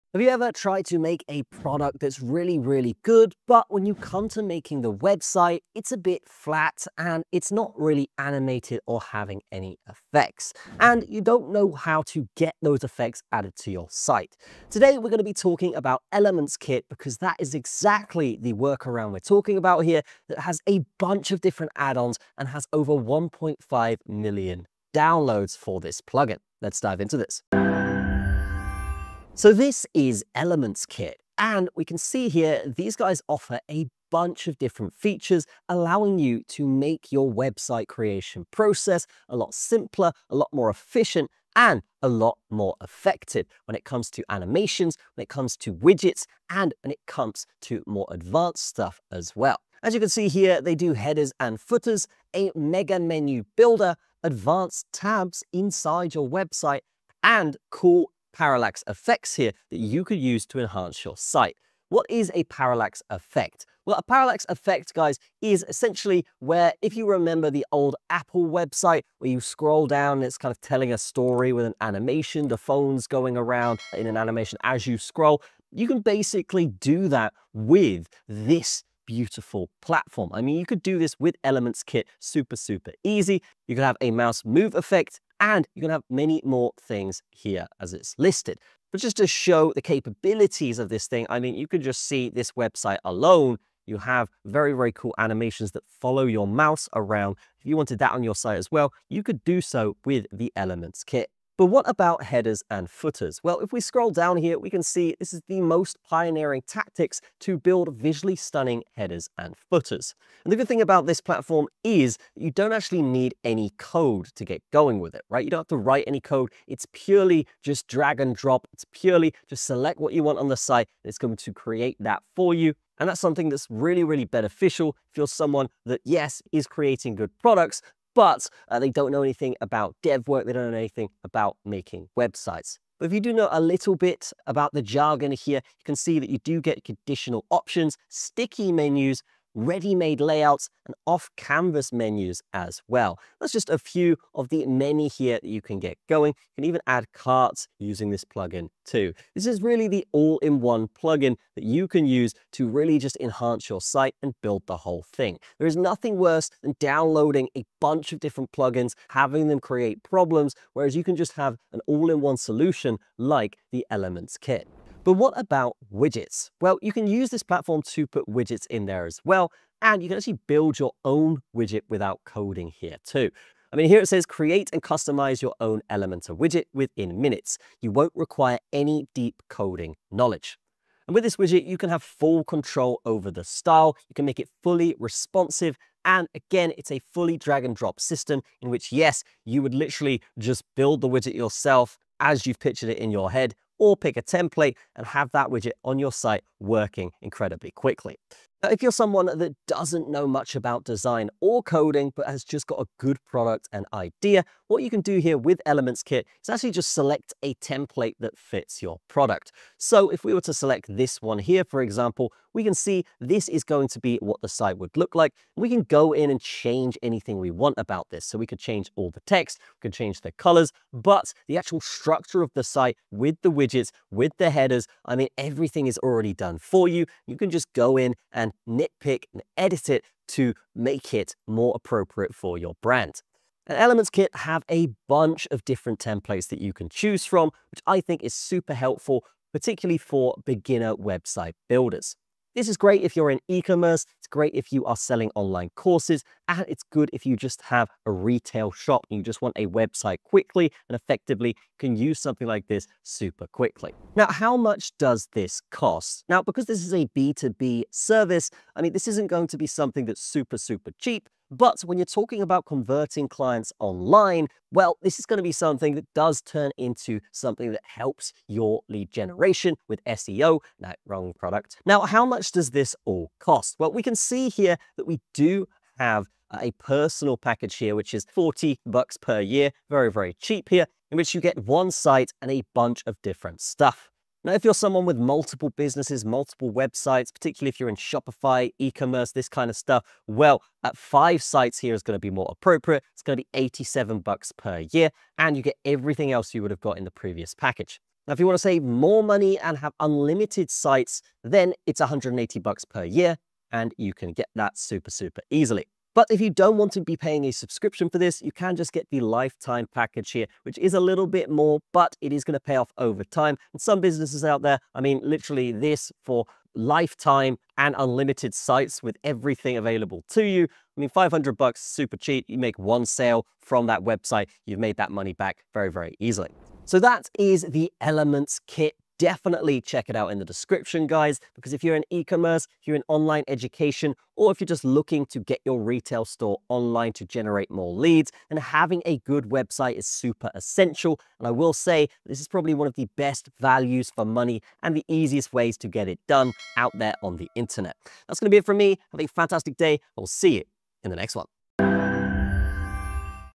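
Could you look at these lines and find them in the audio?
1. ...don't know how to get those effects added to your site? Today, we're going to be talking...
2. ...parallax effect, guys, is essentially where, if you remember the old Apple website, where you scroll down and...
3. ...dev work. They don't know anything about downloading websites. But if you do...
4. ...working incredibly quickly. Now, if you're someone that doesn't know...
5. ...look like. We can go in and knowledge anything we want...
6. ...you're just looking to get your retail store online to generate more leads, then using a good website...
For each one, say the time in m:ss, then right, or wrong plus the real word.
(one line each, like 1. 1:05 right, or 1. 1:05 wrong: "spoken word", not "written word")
1. 0:11 right
2. 1:04 right
3. 2:10 wrong: "making", not "downloading"
4. 3:16 right
5. 3:34 wrong: "change", not "knowledge"
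6. 5:34 wrong: "having", not "using".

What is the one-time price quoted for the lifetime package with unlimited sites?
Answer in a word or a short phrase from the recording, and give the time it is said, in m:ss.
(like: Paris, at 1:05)
$500, at 5:21.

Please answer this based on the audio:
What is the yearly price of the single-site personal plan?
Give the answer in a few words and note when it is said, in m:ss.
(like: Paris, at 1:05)
$40, at 4:38.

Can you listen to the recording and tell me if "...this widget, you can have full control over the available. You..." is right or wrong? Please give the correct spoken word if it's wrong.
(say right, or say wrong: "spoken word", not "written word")
wrong: "style", not "available".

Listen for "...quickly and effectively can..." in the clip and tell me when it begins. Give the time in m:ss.
4:10.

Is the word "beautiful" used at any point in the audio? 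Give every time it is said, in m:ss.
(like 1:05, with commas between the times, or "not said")
1:19.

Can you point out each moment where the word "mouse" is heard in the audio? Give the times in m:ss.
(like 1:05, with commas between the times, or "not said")
1:24, 1:36.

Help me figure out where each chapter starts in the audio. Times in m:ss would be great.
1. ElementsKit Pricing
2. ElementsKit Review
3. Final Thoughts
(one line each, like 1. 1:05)
1. 4:13
2. 0:29
3. 5:27.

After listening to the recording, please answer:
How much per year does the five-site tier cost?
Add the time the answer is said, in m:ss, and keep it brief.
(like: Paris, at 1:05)
$87, at 4:53.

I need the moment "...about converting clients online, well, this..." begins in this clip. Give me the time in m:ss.
4:22.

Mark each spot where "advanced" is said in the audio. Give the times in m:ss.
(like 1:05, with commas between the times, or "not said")
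0:48, 0:54.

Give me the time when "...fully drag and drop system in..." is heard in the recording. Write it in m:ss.
3:07.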